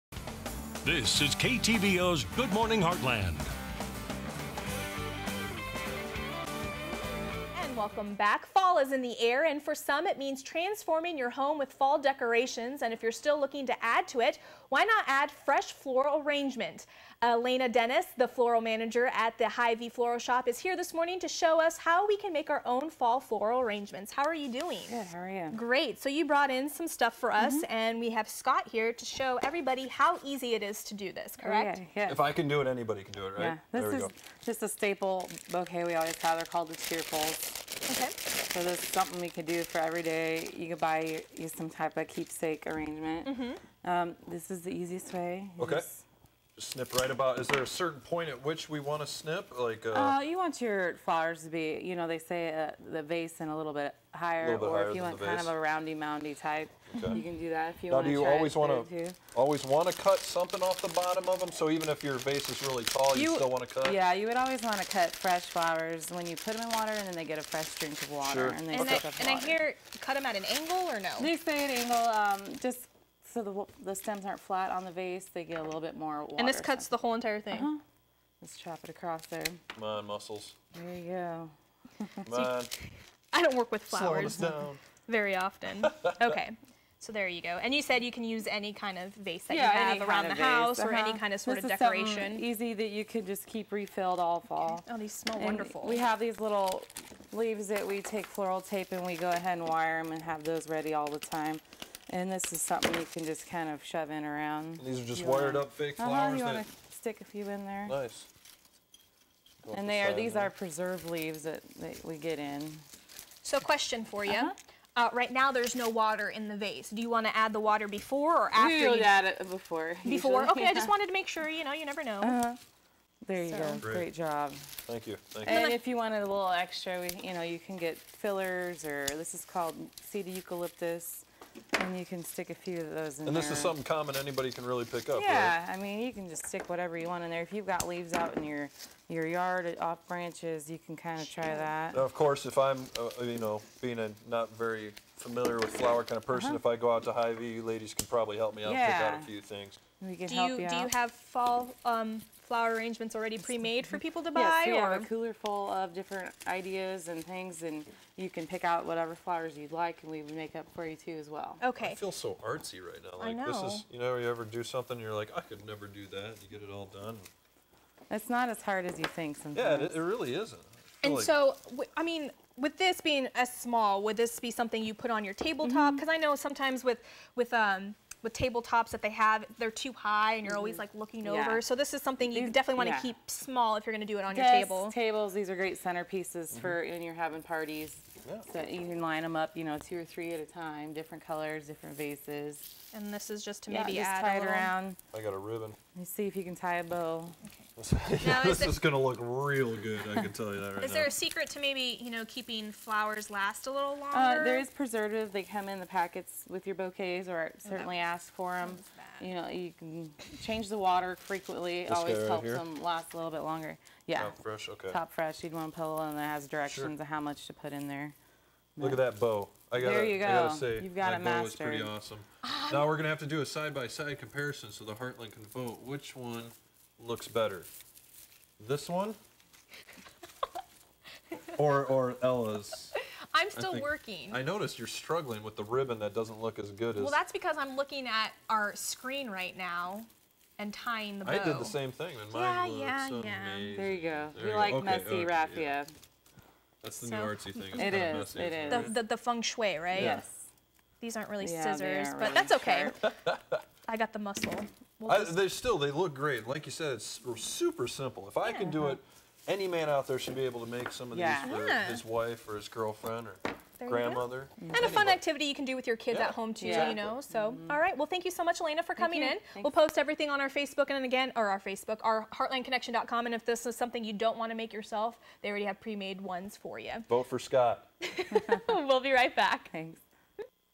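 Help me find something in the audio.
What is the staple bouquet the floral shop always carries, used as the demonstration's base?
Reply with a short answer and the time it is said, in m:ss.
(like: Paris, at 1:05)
The Cheerfuls, at 0:36.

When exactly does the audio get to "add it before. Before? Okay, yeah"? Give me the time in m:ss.
1:59.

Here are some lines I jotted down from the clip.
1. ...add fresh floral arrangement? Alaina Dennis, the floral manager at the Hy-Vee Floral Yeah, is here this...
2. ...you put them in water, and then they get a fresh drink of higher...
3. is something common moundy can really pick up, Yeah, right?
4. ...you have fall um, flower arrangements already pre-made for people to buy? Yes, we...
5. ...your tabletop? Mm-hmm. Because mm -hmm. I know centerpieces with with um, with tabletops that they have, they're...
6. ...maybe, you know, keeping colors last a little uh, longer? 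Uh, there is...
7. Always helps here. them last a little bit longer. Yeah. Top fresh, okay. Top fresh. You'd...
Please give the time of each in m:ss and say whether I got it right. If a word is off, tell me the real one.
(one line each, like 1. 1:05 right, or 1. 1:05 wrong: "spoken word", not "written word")
1. 0:15 wrong: "Shop", not "Yeah"
2. 1:06 wrong: "water", not "higher"
3. 2:13 wrong: "anybody", not "moundy"
4. 2:30 right
5. 2:55 wrong: "sometimes", not "centerpieces"
6. 3:21 wrong: "flowers", not "colors"
7. 3:31 right.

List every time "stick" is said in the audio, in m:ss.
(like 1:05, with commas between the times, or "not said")
1:46, 2:12, 2:16.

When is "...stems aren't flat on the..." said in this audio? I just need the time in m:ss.
1:13.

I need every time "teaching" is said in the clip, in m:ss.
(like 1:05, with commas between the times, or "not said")
not said.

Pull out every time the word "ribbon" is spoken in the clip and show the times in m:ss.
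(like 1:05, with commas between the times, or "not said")
3:15, 3:55.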